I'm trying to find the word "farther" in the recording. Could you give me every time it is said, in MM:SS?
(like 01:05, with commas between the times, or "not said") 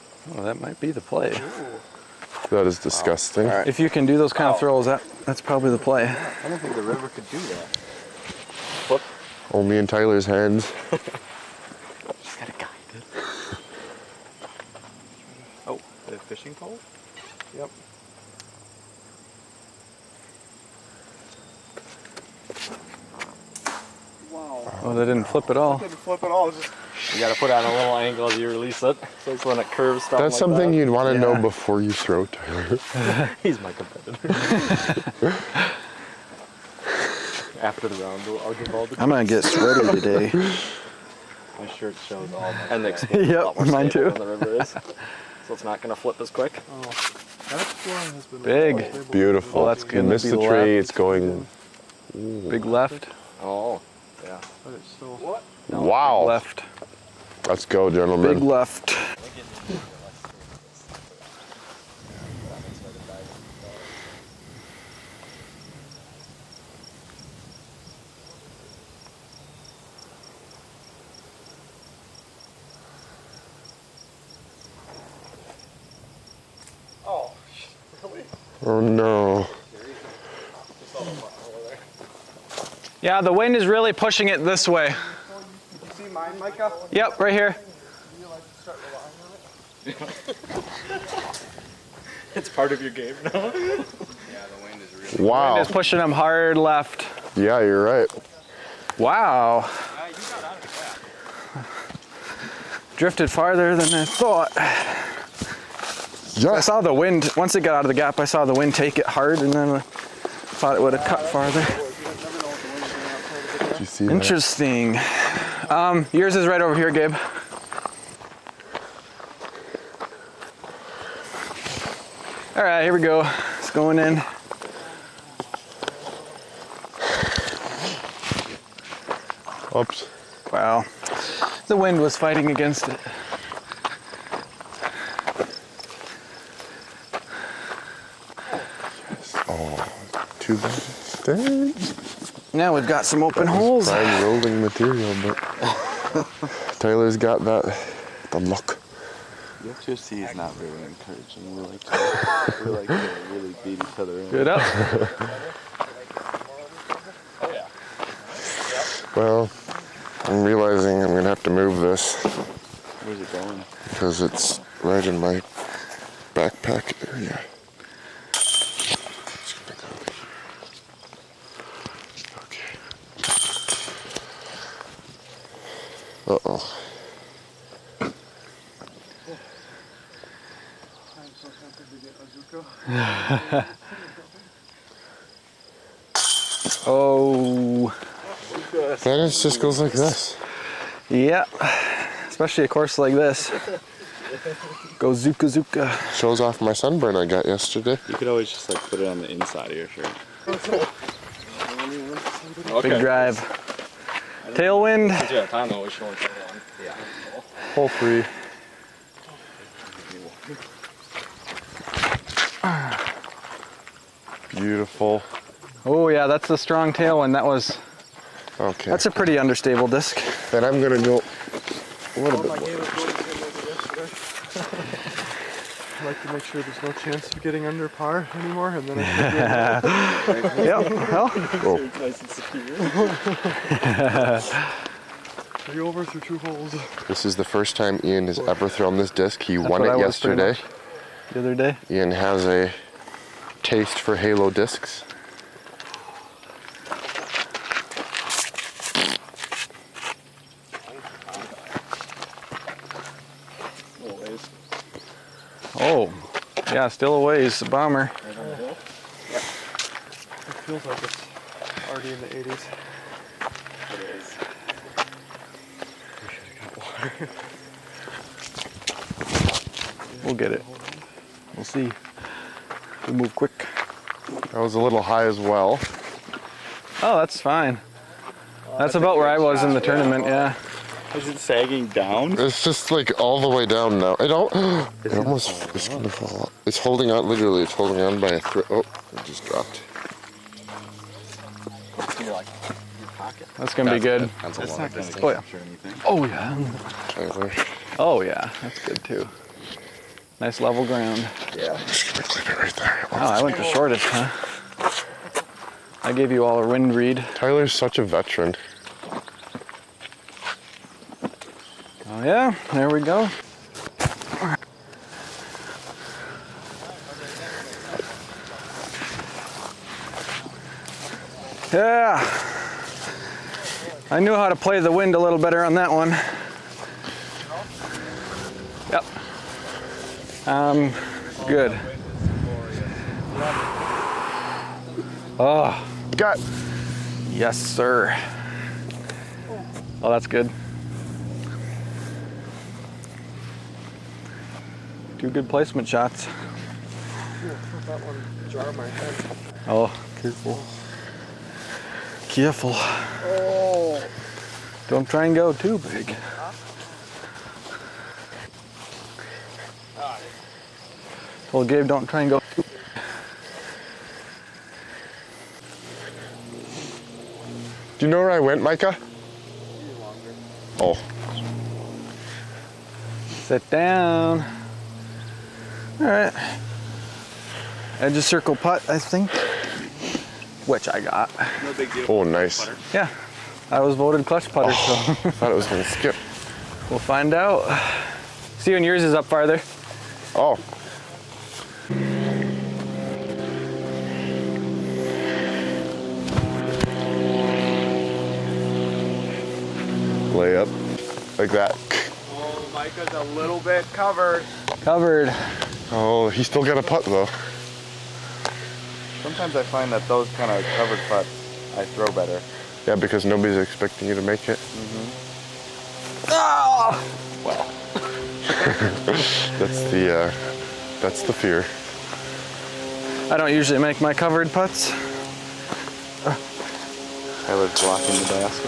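01:43, 01:51, 06:29.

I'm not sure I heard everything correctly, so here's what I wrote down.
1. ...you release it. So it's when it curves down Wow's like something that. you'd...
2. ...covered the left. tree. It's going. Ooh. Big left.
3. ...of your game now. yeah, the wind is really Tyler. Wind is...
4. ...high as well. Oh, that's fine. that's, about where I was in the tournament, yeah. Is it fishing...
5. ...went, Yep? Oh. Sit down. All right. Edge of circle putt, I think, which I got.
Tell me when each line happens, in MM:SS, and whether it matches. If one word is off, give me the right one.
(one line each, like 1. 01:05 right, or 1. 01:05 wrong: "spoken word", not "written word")
1. 00:28 wrong: "That", not "Wow"
2. 00:50 wrong: "missed", not "covered"
3. 01:32 wrong: "Wow", not "Tyler"
4. 04:35 wrong: "sagging", not "fishing"
5. 06:08 wrong: "Micah", not "Yep".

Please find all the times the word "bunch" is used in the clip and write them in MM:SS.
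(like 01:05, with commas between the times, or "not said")
not said.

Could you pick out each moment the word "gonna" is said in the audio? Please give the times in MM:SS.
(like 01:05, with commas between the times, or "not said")
02:41, 03:40, 04:45, 04:53, 06:25.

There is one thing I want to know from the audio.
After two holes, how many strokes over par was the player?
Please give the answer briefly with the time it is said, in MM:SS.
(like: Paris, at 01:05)
3, at 03:55.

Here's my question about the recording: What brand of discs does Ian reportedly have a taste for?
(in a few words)
Halo.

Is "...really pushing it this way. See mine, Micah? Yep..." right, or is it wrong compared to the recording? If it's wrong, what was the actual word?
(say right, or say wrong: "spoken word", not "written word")
right.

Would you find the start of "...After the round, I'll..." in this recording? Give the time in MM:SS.
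00:37.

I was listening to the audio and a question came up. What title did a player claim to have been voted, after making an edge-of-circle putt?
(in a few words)
clutch putter.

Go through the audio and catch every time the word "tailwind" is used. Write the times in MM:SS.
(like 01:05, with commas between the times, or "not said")
03:24, 03:36.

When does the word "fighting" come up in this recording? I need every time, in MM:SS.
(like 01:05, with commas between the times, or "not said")
02:12.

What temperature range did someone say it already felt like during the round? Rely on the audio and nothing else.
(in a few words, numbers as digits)
the 80s.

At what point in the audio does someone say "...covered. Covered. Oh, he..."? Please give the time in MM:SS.
06:43.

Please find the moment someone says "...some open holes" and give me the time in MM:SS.
02:23.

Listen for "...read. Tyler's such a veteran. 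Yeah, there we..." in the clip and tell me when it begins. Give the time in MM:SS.
05:06.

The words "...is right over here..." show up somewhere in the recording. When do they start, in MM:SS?
01:56.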